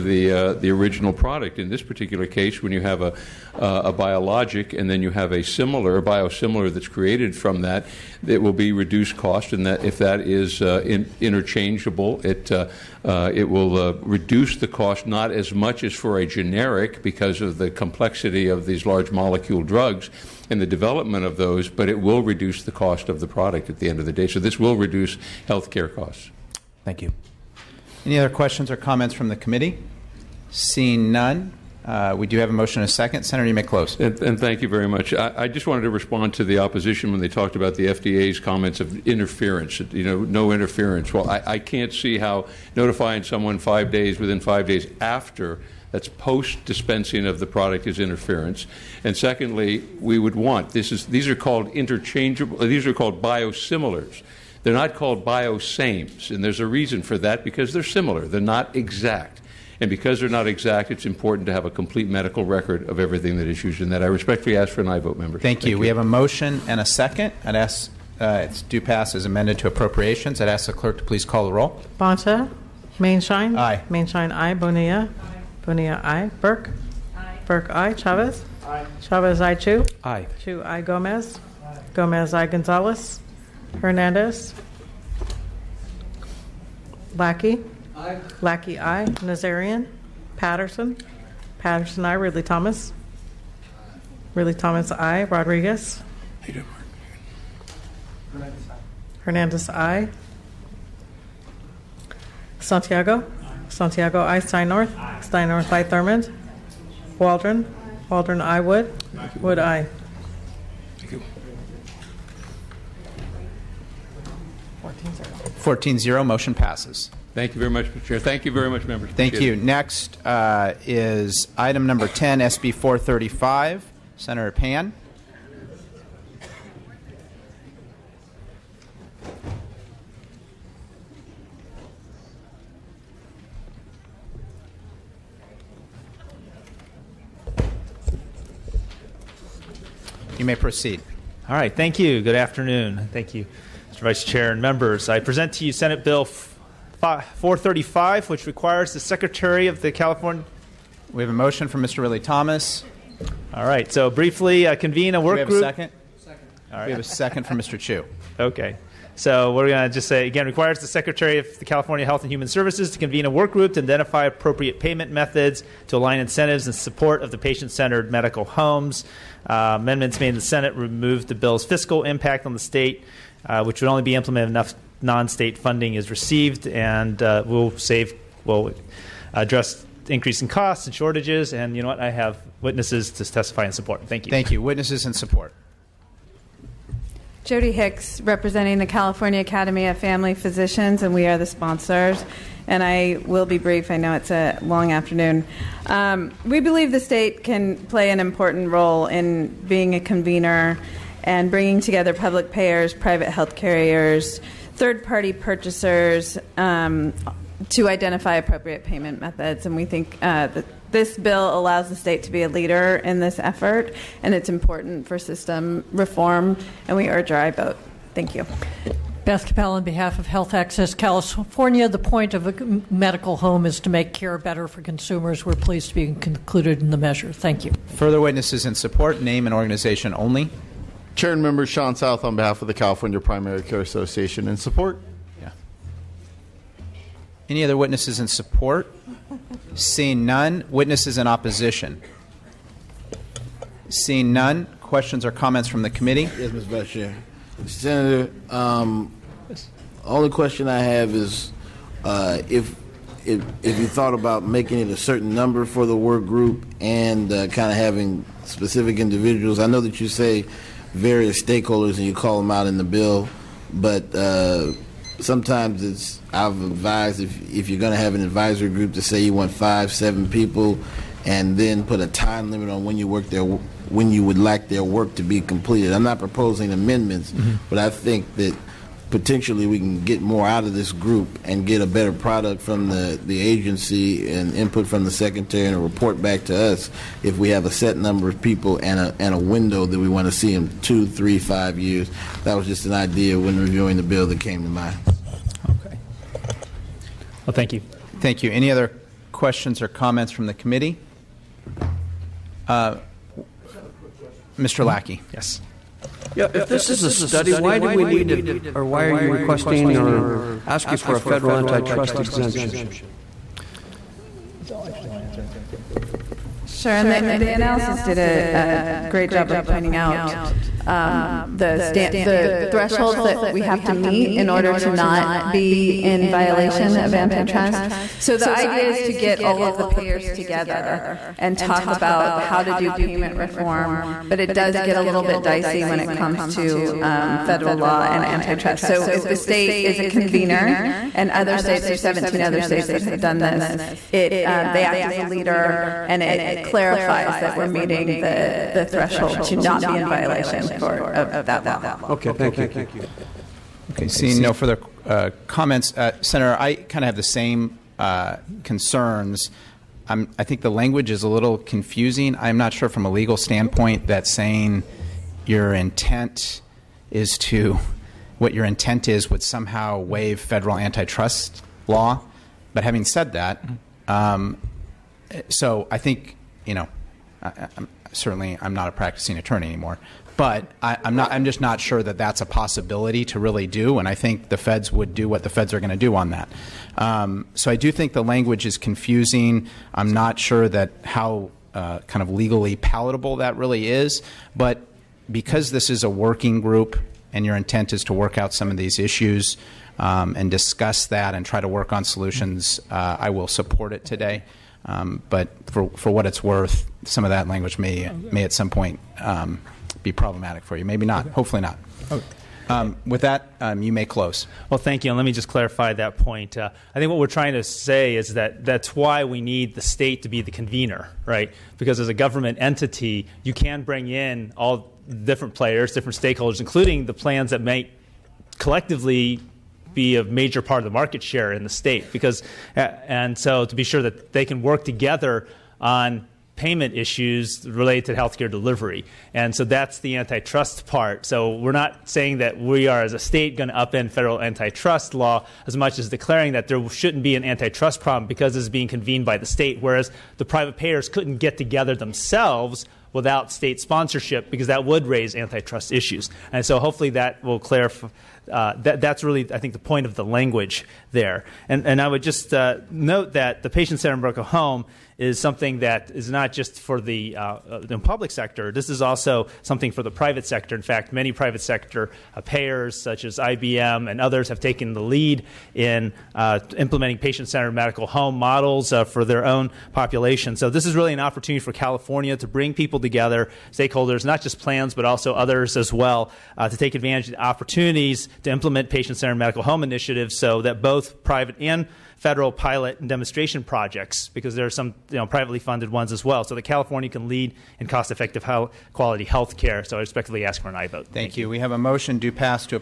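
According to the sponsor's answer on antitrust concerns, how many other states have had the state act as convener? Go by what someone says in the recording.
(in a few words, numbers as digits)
17.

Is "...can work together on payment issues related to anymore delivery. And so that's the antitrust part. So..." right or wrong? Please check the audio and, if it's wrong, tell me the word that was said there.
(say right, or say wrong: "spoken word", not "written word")
wrong: "healthcare", not "anymore".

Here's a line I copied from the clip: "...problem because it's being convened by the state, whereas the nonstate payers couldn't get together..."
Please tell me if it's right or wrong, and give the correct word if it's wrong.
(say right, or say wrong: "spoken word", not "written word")
wrong: "private", not "nonstate".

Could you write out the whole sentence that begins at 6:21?
I'm just not sure that that's a possibility to really do.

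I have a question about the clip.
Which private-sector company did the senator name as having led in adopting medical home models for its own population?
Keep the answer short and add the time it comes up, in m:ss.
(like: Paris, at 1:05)
IBM, at 7:53.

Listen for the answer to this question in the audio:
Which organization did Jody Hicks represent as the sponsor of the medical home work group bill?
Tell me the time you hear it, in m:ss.
3:08.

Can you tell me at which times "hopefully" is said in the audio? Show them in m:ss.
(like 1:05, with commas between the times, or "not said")
6:51, 7:36.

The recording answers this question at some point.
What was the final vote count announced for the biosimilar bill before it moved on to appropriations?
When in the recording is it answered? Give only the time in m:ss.
1:55.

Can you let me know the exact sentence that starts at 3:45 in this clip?
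We're pleased to be included in the measure.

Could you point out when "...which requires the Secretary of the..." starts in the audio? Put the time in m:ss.
2:28.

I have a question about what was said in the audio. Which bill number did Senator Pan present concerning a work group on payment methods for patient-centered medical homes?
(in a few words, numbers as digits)
SB 435.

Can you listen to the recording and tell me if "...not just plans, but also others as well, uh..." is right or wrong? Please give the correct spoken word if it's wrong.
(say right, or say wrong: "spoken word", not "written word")
right.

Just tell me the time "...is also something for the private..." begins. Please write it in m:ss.
7:48.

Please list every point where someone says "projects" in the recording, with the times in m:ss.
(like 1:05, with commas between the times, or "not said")
8:13.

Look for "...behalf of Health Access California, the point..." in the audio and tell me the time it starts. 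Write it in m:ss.
3:39.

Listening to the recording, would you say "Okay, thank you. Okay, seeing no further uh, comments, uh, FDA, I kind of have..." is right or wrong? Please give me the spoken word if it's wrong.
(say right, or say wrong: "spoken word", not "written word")
wrong: "Senator", not "FDA".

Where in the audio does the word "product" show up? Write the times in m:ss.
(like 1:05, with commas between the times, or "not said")
0:01, 0:23, 0:47, 4:42.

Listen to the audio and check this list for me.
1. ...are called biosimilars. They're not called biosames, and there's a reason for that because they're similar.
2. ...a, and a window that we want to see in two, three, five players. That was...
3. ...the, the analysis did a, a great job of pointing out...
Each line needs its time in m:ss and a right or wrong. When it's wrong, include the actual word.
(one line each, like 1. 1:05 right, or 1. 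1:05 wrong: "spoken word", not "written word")
1. 0:52 right
2. 4:48 wrong: "years", not "players"
3. 5:17 right.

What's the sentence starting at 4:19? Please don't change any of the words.
I know that you say various stakeholders and you call them out in the bill.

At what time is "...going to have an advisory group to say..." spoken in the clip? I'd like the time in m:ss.
4:27.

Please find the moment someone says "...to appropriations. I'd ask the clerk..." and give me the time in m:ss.
1:09.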